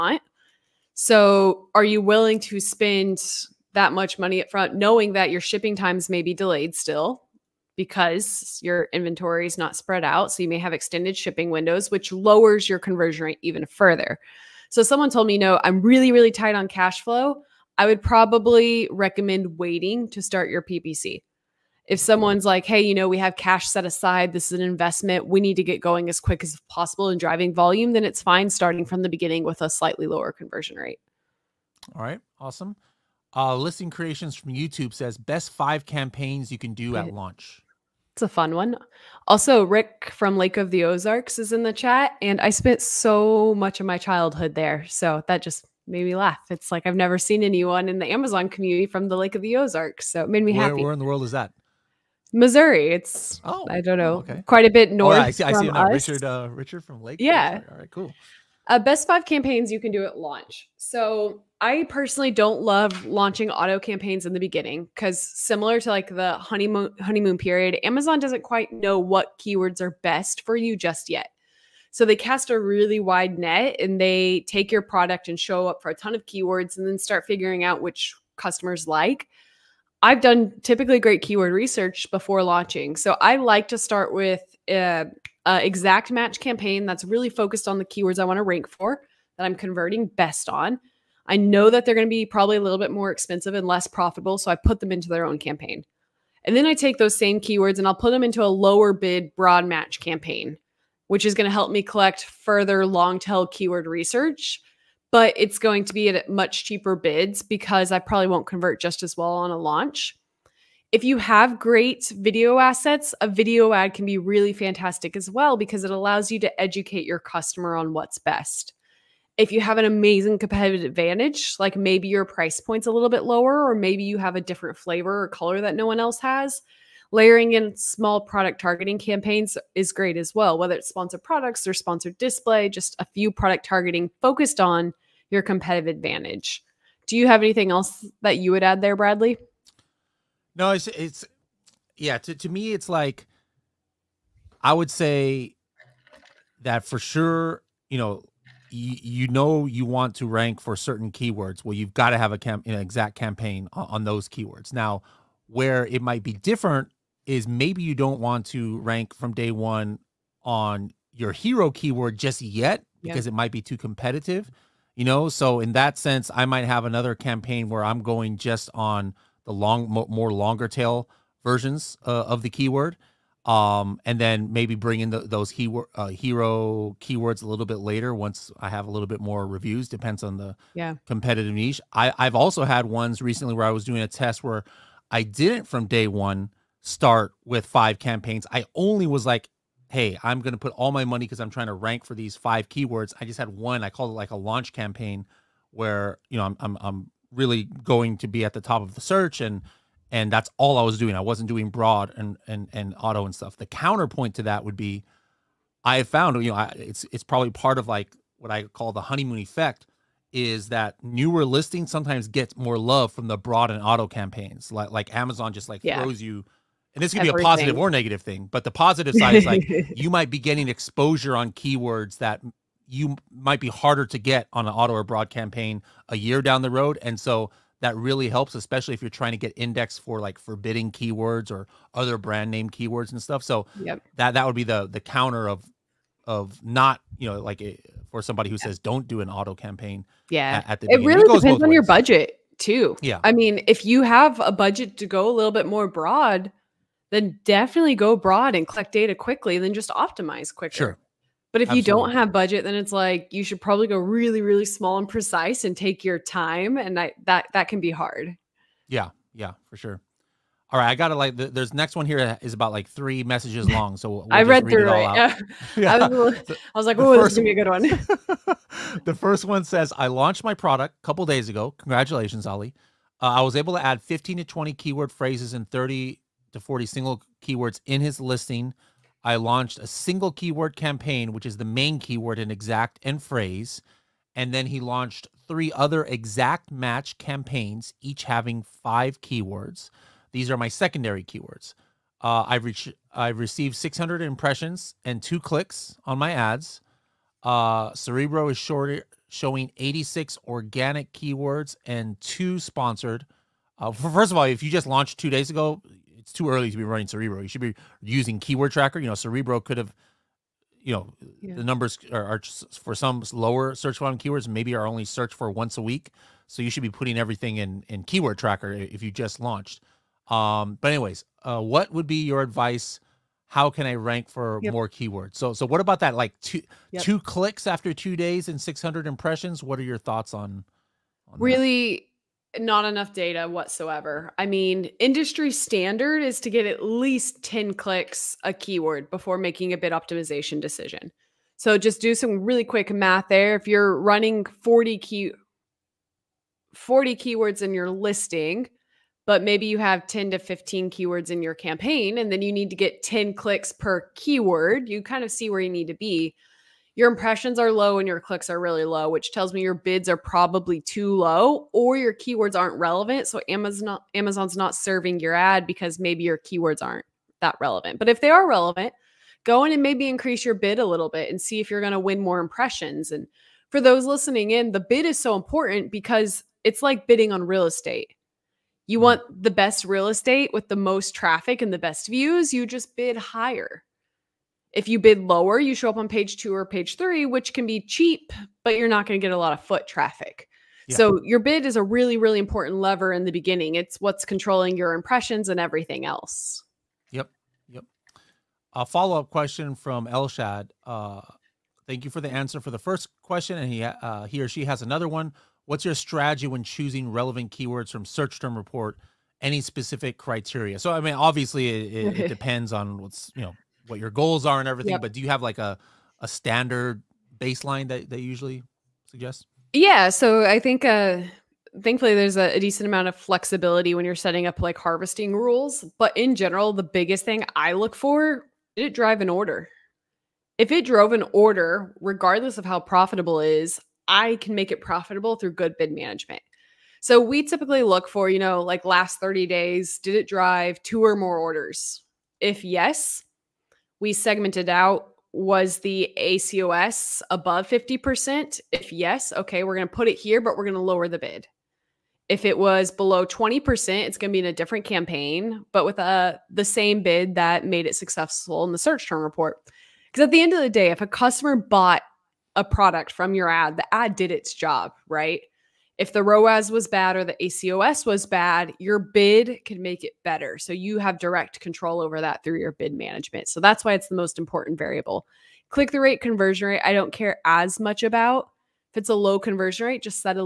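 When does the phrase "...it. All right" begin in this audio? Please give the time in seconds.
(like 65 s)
264 s.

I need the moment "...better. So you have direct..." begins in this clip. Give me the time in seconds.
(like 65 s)
470 s.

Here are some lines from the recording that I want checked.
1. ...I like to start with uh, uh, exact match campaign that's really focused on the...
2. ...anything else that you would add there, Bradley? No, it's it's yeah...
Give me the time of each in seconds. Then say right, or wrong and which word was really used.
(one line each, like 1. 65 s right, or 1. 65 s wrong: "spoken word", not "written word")
1. 83 s right
2. 137 s right.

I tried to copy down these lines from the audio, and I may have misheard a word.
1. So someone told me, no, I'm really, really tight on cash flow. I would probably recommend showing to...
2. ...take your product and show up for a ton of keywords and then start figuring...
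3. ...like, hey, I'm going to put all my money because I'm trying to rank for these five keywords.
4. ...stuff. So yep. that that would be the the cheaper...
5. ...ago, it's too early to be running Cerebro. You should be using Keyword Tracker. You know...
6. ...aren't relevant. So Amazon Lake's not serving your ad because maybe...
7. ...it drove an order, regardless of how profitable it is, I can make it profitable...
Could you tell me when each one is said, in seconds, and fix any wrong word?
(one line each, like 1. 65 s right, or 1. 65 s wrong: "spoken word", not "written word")
1. 14 s wrong: "waiting", not "showing"
2. 74 s right
3. 189 s right
4. 233 s wrong: "counter", not "cheaper"
5. 305 s right
6. 362 s wrong: "Amazon", not "Lake"
7. 430 s right.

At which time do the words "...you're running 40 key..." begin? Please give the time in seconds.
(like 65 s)
343 s.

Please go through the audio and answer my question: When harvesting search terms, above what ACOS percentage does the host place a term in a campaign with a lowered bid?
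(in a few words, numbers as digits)
50%.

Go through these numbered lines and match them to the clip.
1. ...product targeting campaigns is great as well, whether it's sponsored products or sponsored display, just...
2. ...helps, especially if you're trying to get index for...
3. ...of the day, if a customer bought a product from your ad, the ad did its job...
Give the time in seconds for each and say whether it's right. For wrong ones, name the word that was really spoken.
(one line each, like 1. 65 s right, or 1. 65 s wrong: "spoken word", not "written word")
1. 128 s right
2. 228 s right
3. 460 s right.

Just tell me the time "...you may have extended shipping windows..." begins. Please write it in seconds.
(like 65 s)
10 s.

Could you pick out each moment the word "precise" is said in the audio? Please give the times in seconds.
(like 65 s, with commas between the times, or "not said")
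255 s.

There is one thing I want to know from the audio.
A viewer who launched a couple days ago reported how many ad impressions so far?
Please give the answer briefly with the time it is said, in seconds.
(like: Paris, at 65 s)
600, at 293 s.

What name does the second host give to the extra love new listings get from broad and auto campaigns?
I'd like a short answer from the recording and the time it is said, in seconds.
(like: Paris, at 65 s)
honeymoon effect, at 209 s.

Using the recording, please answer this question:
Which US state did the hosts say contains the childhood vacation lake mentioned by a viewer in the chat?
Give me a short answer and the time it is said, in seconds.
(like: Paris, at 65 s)
Missouri, at 52 s.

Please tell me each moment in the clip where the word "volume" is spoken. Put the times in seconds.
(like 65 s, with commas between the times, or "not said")
27 s, 313 s.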